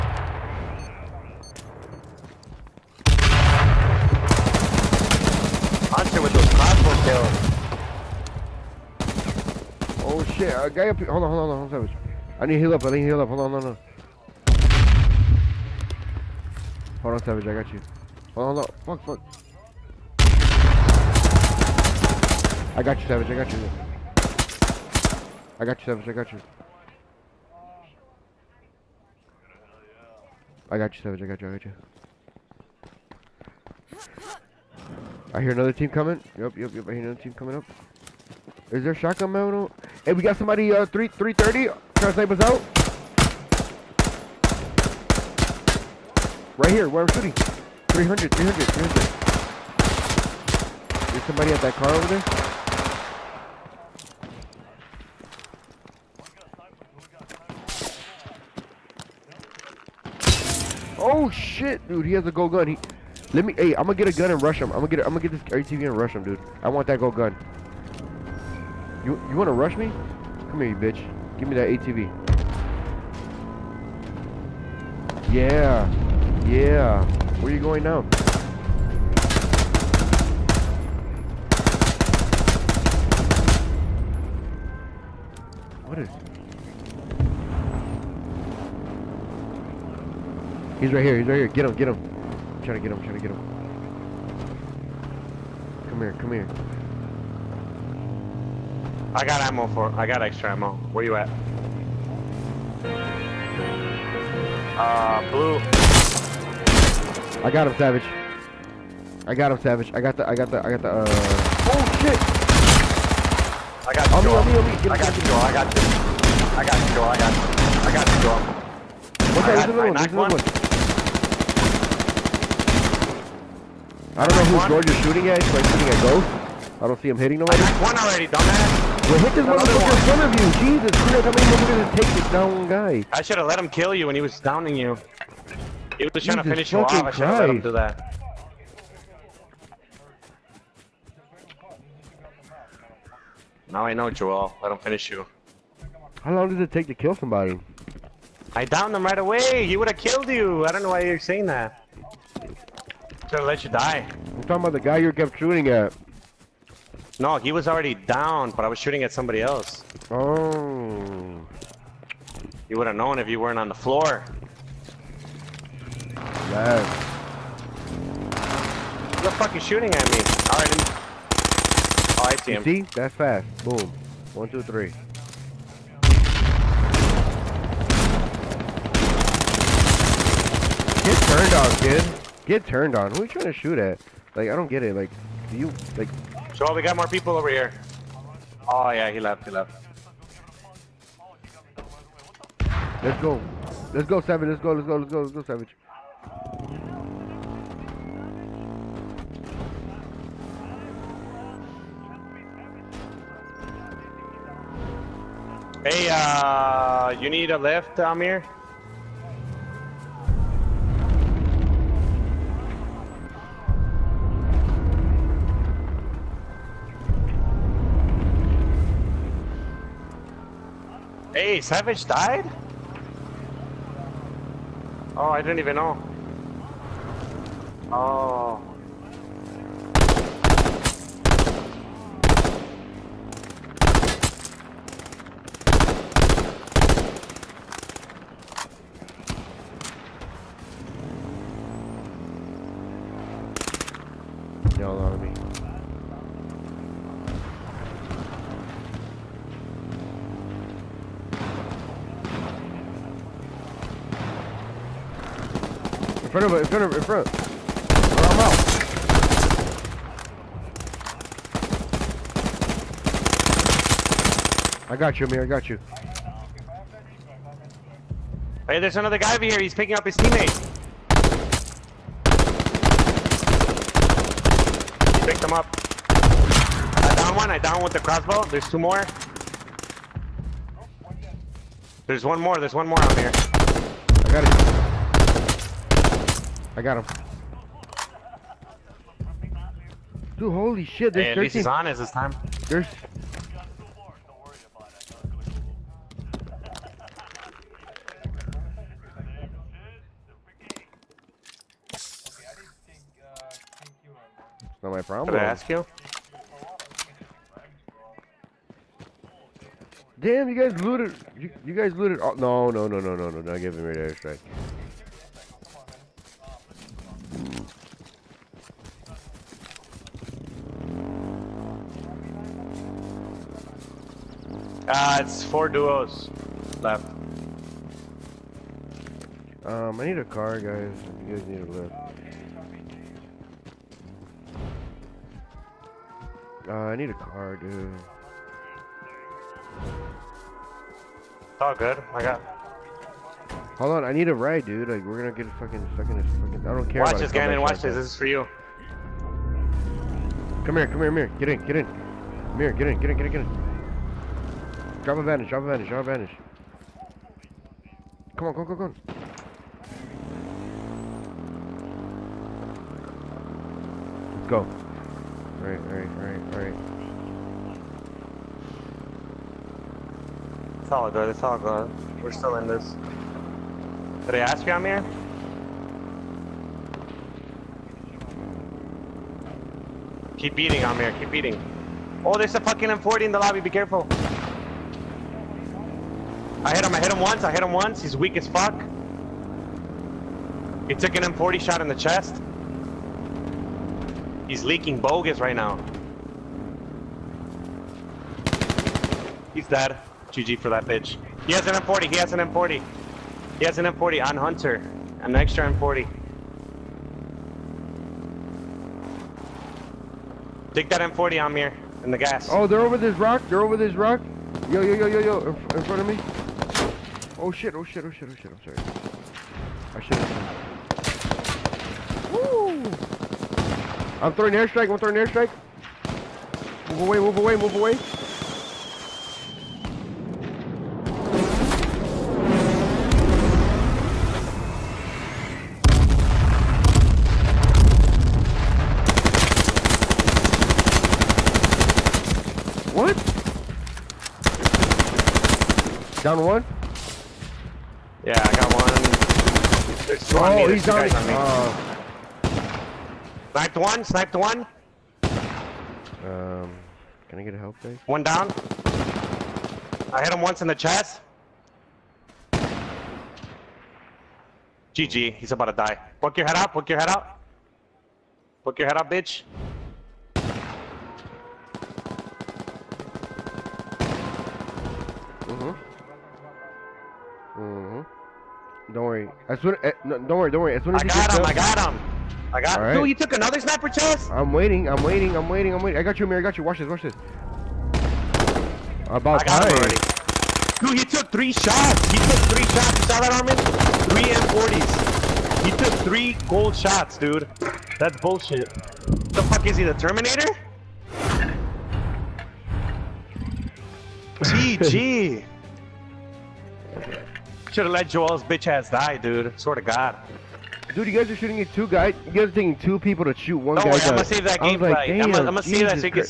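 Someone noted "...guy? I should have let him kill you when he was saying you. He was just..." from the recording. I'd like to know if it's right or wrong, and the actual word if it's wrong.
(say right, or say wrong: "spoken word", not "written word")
wrong: "downing", not "saying".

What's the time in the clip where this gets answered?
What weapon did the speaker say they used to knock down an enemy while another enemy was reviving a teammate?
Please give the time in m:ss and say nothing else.
4:37.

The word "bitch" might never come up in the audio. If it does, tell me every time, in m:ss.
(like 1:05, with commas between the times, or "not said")
1:10, 6:40, 7:49, 8:28.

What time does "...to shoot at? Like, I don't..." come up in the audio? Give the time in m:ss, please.
3:03.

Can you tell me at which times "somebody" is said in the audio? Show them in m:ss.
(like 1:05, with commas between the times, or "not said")
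0:40, 0:51, 2:27, 2:39.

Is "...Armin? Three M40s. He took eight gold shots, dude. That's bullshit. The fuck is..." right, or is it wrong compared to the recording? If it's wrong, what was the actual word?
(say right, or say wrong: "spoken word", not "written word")
wrong: "three", not "eight".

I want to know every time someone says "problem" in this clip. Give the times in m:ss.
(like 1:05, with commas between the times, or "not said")
5:05.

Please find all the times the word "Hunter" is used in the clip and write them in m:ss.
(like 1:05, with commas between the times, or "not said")
0:05, 6:44.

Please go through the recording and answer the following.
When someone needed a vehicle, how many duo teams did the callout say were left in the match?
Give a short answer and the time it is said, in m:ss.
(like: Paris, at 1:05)
4, at 5:25.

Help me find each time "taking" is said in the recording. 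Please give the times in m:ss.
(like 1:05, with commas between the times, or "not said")
8:32.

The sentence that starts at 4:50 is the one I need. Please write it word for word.
Dude, holy shit, there's hey, at 13.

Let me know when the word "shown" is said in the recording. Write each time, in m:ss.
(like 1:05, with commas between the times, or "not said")
not said.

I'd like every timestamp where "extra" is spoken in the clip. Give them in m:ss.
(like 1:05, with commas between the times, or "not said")
1:40, 6:45.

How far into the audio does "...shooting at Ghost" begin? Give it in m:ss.
2:05.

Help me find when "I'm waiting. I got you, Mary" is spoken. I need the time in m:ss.
8:05.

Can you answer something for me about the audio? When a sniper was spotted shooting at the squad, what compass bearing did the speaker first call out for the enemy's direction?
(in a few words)
330.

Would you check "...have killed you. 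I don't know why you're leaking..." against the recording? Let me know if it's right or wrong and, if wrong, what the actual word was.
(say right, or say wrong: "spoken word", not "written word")
wrong: "saying", not "leaking".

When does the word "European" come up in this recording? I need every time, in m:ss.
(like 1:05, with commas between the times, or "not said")
not said.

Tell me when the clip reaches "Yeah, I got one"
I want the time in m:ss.
7:28.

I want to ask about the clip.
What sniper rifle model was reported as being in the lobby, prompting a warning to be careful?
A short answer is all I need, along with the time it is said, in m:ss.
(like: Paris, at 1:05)
M40, at 6:22.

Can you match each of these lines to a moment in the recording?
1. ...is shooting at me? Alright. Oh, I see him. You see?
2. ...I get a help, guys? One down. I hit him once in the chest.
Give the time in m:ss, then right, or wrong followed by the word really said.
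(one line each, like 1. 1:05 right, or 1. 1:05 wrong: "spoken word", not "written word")
1. 2:49 right
2. 7:37 right.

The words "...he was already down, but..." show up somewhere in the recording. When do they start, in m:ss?
2:37.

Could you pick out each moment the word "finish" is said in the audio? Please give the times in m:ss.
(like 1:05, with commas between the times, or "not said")
2:16, 2:24.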